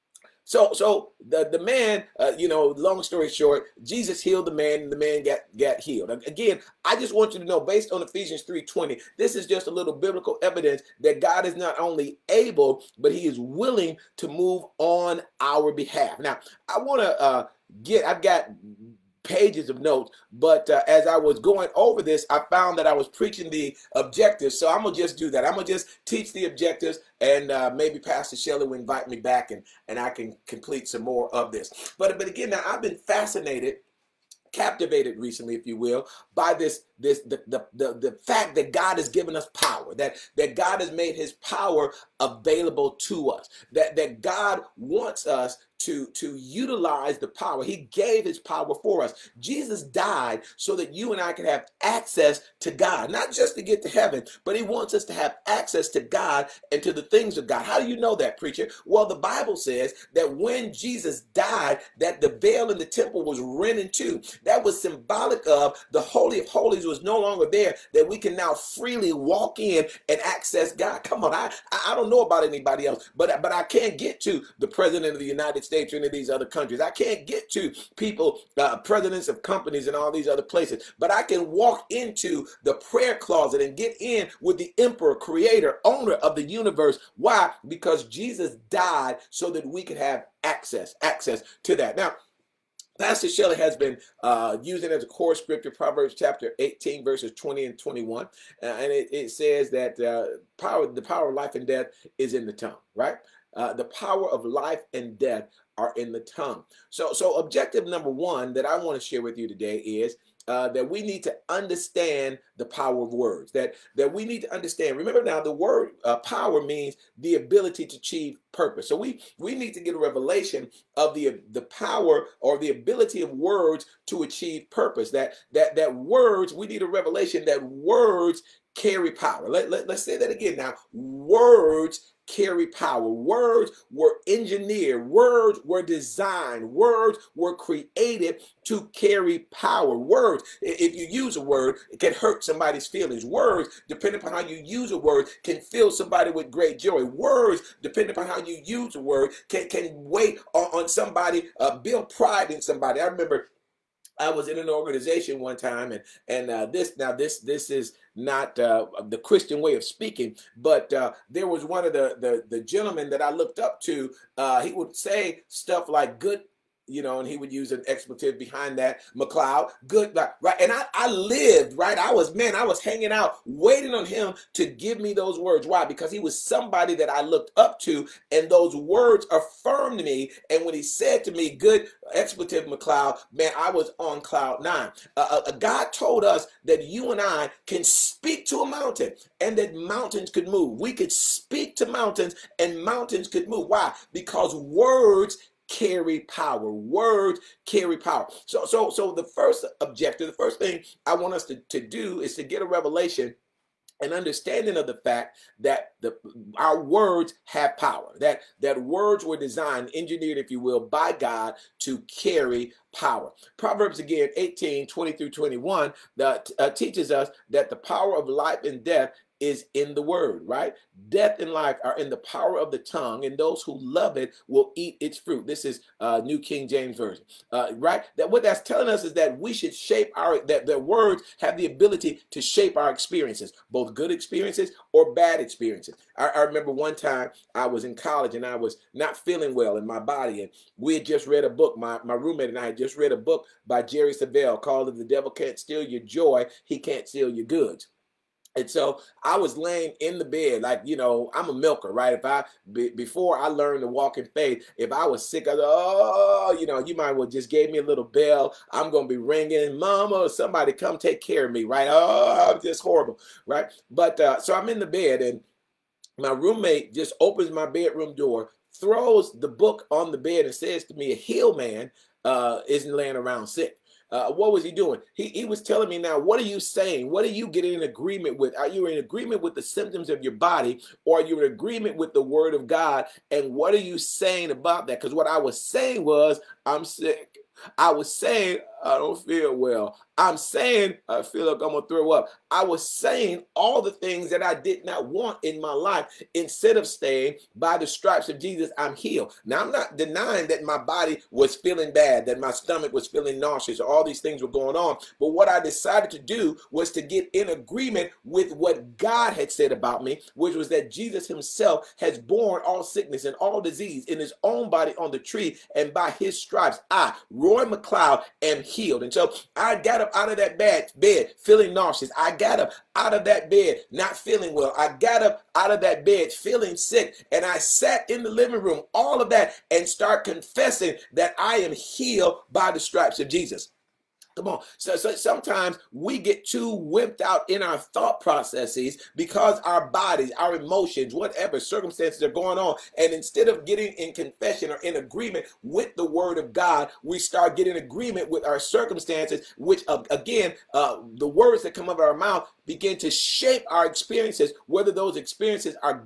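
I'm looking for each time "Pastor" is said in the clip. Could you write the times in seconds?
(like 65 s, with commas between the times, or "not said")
27 s, 92 s.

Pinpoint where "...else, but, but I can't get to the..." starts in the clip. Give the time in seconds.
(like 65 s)
72 s.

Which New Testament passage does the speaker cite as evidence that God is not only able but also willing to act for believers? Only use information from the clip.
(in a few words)
Ephesians 3:20.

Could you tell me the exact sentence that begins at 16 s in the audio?
Now, I want to uh, get, I've got pages of notes.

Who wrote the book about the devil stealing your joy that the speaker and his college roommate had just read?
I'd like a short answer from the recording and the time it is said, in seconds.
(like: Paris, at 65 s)
Jerry Savelle, at 243 s.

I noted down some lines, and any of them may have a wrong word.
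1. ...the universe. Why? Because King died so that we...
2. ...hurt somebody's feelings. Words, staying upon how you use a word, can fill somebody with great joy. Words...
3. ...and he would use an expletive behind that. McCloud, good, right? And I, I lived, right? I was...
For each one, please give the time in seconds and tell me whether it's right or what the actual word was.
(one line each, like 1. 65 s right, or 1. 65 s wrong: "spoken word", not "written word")
1. 86 s wrong: "Jesus", not "King"
2. 142 s wrong: "depending", not "staying"
3. 167 s right.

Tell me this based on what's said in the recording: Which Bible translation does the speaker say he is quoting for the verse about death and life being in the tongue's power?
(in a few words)
New King James Version.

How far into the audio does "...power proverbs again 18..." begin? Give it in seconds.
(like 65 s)
212 s.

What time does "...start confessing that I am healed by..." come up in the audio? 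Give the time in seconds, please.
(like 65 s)
329 s.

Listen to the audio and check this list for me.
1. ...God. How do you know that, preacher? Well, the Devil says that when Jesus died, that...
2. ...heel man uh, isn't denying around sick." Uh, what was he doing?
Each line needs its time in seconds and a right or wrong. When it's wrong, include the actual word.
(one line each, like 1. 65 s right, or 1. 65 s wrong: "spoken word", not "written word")
1. 57 s wrong: "Bible", not "Devil"
2. 271 s wrong: "laying", not "denying".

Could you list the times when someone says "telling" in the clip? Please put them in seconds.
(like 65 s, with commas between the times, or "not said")
228 s, 275 s.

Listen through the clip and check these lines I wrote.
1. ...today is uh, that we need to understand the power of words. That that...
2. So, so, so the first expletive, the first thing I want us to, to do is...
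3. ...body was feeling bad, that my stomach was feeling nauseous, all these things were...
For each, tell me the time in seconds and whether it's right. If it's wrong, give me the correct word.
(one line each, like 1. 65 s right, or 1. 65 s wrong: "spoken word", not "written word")
1. 109 s right
2. 198 s wrong: "objective", not "expletive"
3. 300 s right.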